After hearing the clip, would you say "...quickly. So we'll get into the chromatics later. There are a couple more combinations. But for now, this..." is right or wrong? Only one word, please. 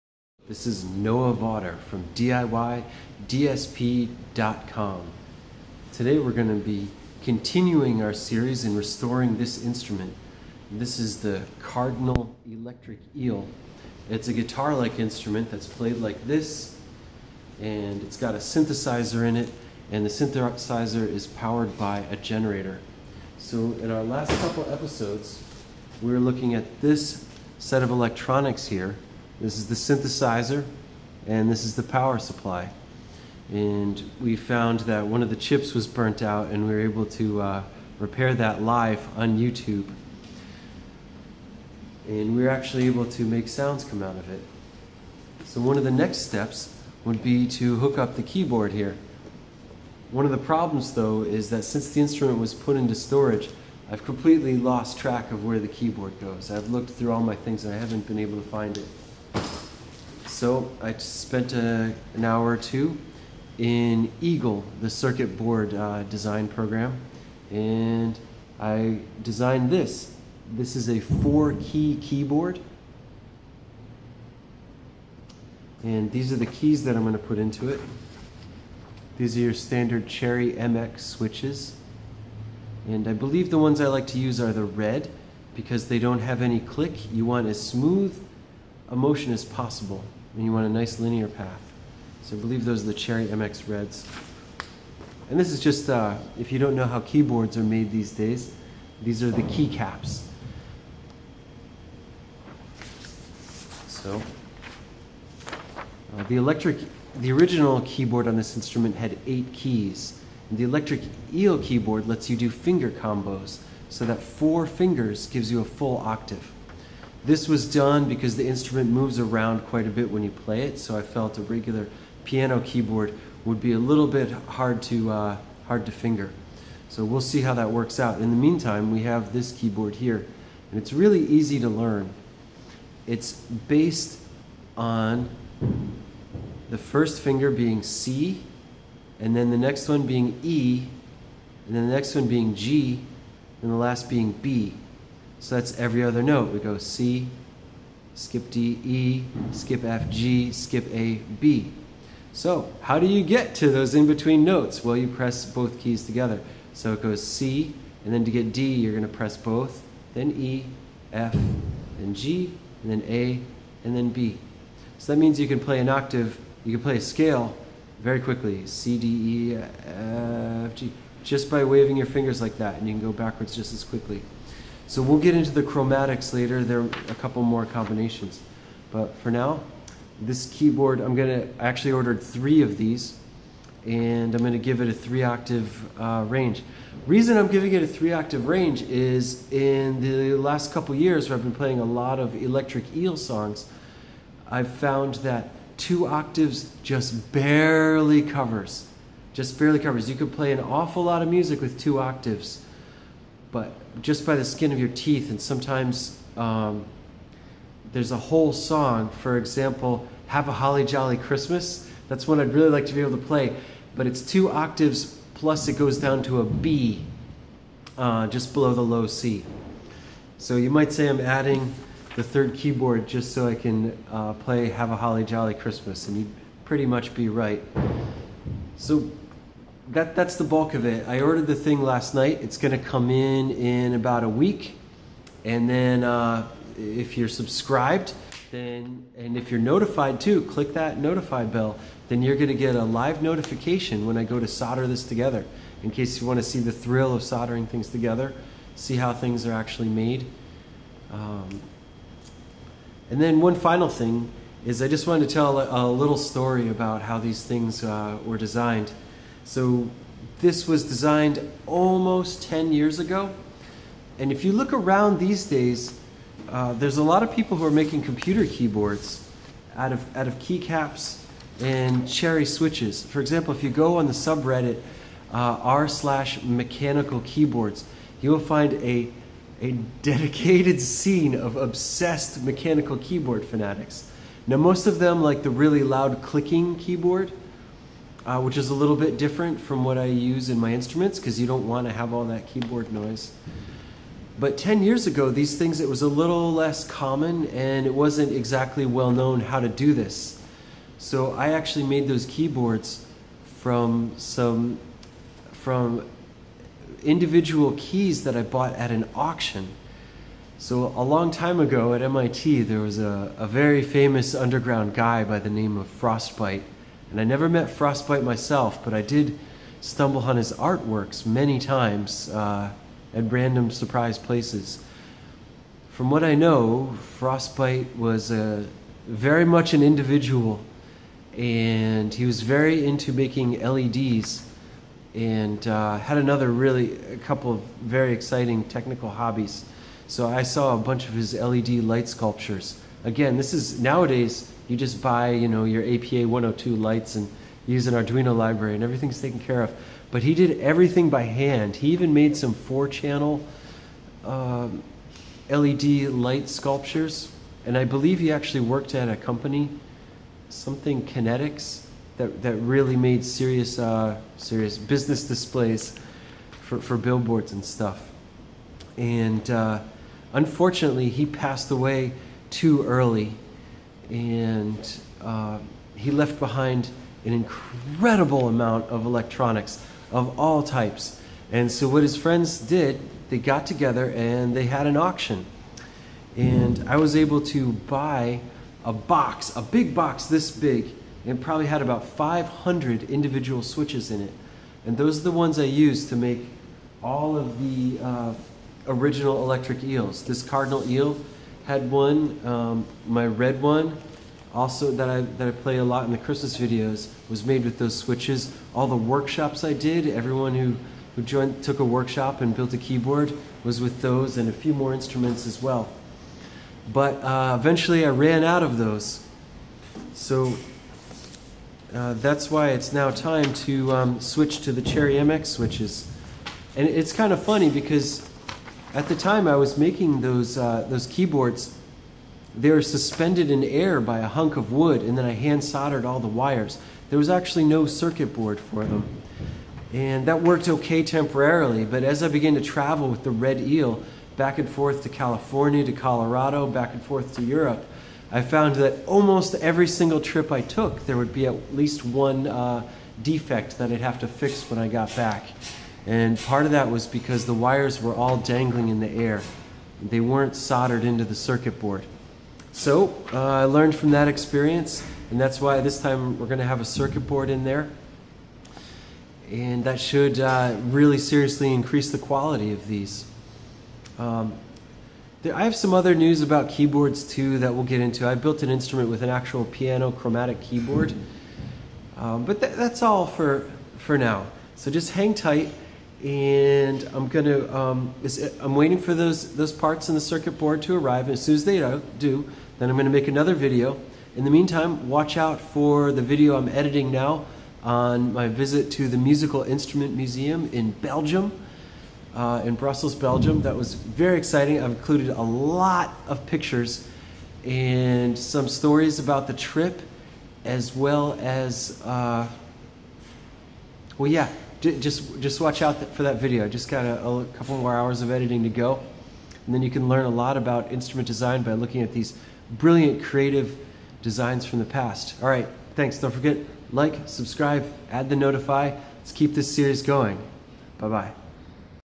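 right.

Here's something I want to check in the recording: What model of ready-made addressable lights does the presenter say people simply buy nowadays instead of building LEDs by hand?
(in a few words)
APA 102.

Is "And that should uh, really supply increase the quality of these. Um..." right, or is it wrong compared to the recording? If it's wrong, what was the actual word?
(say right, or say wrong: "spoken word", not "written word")
wrong: "seriously", not "supply".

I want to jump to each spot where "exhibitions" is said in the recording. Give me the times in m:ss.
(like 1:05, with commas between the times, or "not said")
not said.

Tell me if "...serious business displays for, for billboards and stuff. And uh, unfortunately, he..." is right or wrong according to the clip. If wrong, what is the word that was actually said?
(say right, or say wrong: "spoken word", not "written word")
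right.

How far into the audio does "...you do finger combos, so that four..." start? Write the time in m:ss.
1:52.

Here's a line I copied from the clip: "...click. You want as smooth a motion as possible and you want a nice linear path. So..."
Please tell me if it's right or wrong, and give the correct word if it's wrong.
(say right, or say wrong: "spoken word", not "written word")
right.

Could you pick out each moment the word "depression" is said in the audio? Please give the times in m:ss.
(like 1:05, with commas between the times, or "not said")
not said.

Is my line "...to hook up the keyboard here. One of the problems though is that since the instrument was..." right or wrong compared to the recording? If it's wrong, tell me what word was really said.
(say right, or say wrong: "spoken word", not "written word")
right.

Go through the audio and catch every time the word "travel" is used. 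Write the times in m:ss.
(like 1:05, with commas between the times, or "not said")
7:22.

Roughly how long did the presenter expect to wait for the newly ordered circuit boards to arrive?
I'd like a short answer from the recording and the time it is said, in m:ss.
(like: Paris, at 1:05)
About a week, at 3:53.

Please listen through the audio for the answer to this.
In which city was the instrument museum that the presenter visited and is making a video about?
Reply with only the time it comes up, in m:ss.
8:22.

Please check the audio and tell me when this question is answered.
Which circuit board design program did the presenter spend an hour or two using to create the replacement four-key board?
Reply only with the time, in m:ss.
1:04.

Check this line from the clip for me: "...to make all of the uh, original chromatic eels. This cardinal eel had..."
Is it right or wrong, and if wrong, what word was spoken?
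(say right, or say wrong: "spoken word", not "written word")
wrong: "electric", not "chromatic".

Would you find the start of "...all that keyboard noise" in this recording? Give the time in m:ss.
4:52.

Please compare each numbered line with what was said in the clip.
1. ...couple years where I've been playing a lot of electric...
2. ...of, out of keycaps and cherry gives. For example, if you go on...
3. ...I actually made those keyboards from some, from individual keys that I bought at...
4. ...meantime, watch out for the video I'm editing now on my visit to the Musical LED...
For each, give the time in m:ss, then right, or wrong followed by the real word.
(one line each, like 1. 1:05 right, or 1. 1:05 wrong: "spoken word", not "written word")
1. 3:10 right
2. 4:29 wrong: "switches", not "gives"
3. 5:01 right
4. 8:14 wrong: "Instrument", not "LED".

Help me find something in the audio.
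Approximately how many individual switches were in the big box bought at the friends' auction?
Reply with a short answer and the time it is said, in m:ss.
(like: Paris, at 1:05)
500, at 6:32.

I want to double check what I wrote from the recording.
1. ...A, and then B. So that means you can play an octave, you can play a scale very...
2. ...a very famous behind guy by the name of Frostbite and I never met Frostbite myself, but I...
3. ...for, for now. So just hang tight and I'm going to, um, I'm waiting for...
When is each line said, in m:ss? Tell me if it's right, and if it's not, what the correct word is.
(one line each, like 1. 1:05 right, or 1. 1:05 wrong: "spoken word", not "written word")
1. 2:43 right
2. 5:13 wrong: "underground", not "behind"
3. 8:03 right.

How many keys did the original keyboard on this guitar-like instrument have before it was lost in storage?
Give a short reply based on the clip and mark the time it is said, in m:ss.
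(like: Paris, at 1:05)
8, at 1:49.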